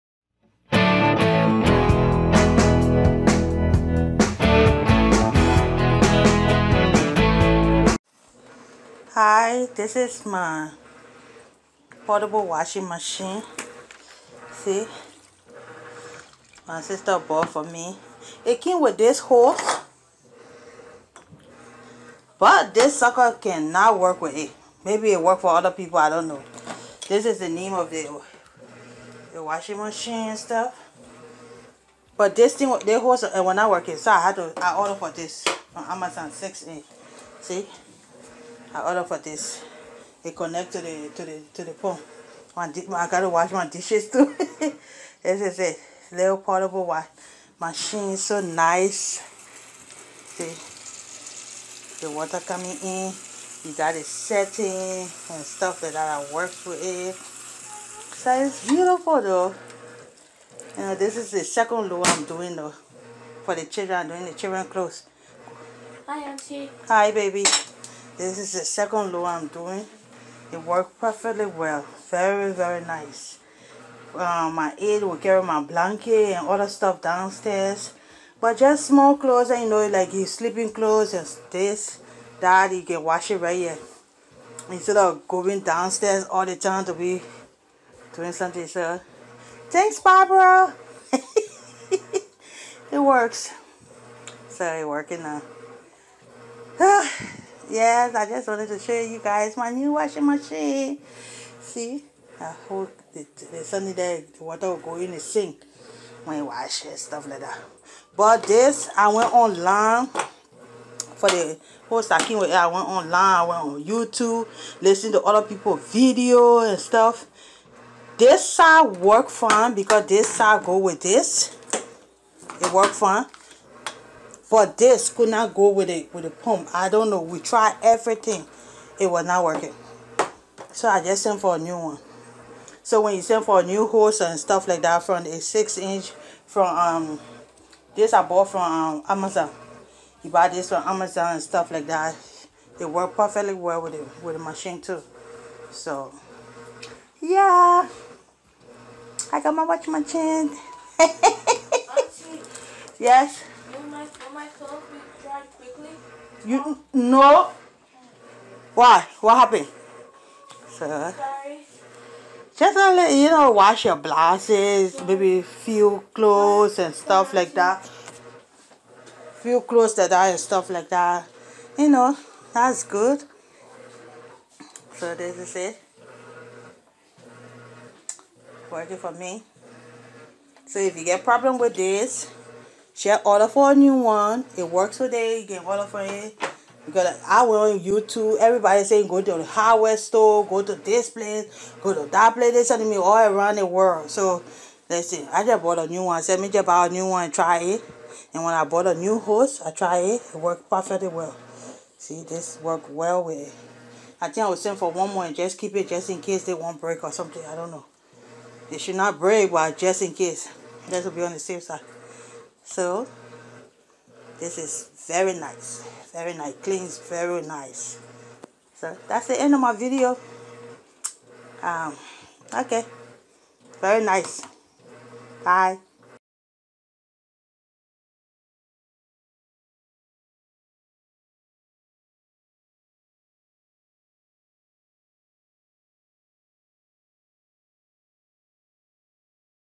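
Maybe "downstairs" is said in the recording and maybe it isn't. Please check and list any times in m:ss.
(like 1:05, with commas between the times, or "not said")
1:17, 1:25.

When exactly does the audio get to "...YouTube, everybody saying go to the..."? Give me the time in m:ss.
3:07.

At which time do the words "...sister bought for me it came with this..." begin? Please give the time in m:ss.
0:16.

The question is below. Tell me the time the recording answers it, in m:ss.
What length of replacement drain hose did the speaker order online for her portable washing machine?
0:36.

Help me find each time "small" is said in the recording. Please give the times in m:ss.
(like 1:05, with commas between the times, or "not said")
1:18.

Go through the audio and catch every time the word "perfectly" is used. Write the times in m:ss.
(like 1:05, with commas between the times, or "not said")
1:10, 2:23, 3:20.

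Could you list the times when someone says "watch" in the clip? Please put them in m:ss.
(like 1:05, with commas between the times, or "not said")
2:29.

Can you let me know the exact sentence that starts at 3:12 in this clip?
they sending me all around the world.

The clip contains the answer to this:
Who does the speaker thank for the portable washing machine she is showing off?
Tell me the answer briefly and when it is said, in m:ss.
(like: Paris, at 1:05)
Barbara, at 1:29.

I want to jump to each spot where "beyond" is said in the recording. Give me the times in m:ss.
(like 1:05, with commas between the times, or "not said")
not said.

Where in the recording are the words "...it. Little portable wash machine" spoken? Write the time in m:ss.
0:45.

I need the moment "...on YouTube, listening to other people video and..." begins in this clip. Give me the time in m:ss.
1:53.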